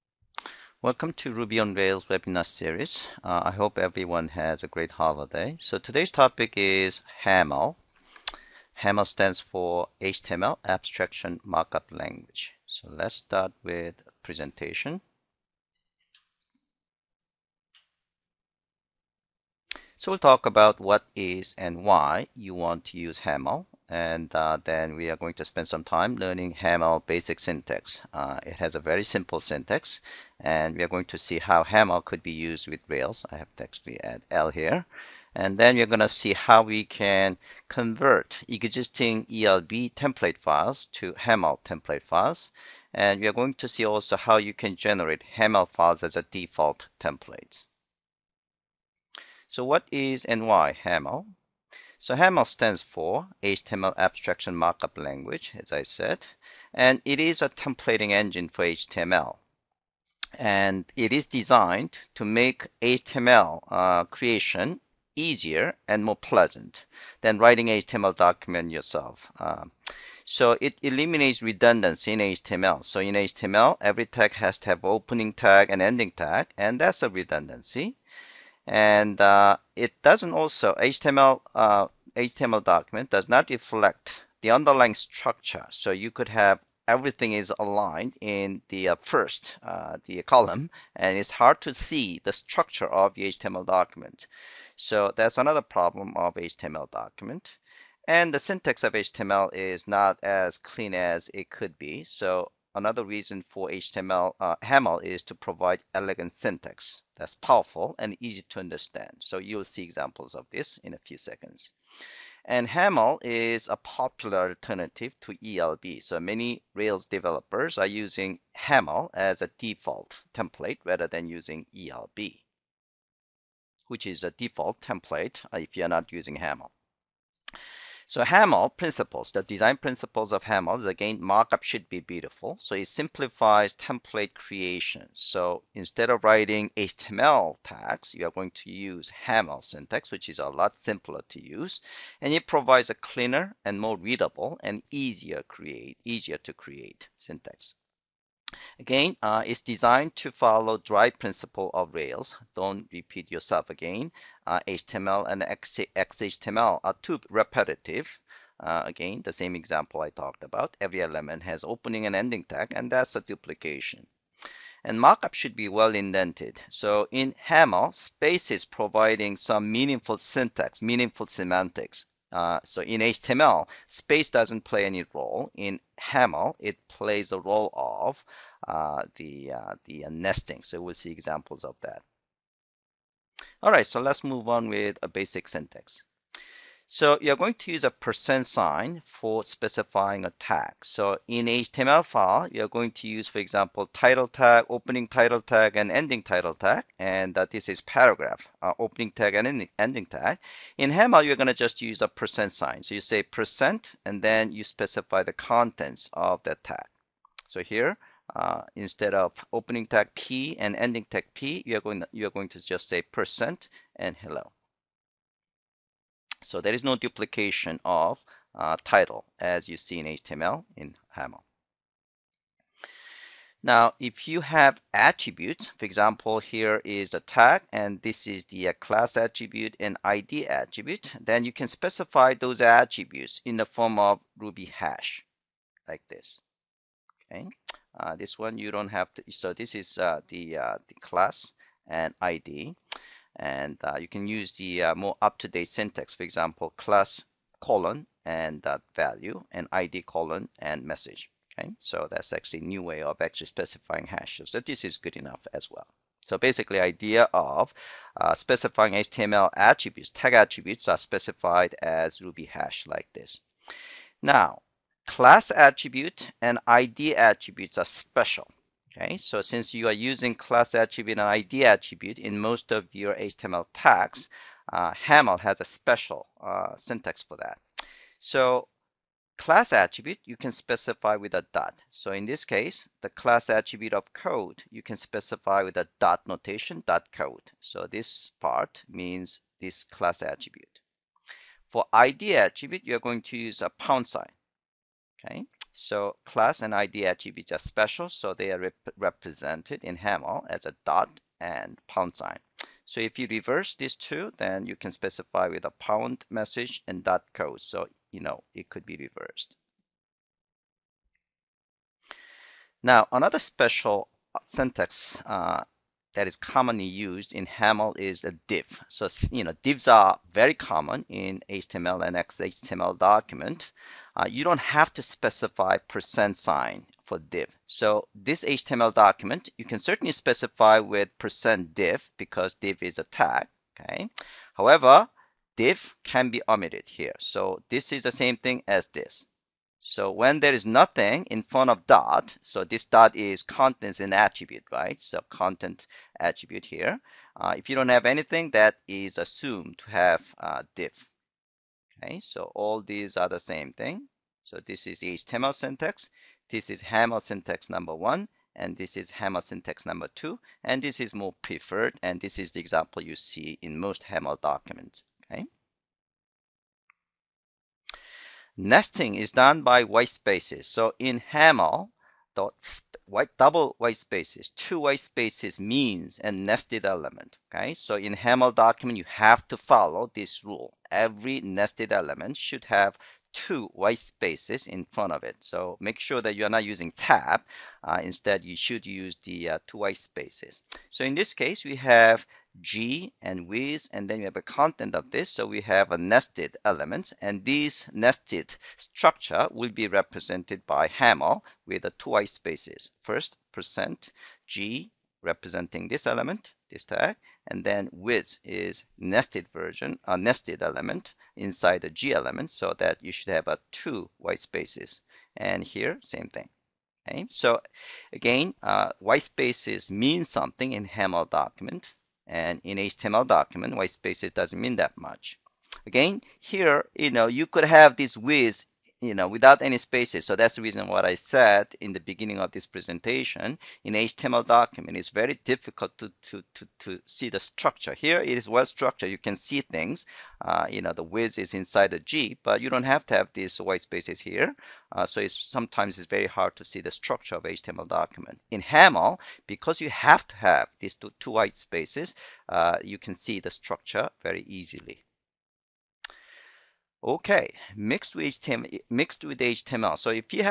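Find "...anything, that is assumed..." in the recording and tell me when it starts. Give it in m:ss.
5:48.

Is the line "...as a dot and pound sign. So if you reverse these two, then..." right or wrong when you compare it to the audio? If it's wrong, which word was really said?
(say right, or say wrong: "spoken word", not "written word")
right.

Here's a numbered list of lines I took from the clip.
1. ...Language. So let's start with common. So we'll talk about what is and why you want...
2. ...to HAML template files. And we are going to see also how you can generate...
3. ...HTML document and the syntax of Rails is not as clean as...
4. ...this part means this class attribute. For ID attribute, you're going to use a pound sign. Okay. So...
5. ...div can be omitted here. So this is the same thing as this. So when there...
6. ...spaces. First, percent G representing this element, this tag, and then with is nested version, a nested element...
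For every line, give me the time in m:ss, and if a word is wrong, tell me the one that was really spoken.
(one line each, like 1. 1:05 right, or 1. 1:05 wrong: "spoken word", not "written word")
1. 0:11 wrong: "presentation", not "common"
2. 0:40 right
3. 1:36 wrong: "HTML", not "Rails"
4. 4:47 right
5. 5:35 right
6. 6:42 right.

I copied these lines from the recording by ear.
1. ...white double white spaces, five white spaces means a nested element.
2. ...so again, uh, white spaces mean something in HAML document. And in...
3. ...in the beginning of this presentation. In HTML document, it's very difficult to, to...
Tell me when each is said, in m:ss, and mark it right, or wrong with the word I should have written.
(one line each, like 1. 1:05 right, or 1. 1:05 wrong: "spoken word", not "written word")
1. 6:13 wrong: "two", not "five"
2. 6:57 right
3. 7:11 right.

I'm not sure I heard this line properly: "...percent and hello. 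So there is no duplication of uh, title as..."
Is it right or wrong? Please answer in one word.
right.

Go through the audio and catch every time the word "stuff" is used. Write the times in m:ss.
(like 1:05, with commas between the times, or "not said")
not said.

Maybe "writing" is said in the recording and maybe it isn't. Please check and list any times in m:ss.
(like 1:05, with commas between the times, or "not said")
1:07, 2:16.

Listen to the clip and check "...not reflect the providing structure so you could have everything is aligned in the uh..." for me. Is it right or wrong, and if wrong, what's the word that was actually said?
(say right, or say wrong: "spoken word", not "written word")
wrong: "underlying", not "providing".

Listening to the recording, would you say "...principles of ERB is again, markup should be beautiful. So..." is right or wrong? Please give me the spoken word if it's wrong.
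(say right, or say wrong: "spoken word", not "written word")
wrong: "HAML", not "ERB".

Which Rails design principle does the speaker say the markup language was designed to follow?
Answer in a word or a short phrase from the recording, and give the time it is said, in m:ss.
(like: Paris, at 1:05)
dry principle, at 2:30.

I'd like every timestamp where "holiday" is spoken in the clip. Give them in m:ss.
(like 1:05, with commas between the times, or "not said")
0:04.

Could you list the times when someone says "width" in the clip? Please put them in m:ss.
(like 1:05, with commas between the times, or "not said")
7:08, 7:21.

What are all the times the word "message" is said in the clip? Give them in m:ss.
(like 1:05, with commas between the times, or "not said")
4:10, 5:06.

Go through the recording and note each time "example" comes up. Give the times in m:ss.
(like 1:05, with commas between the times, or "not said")
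1:49, 2:39, 3:01, 3:13, 3:45, 4:06, 6:02.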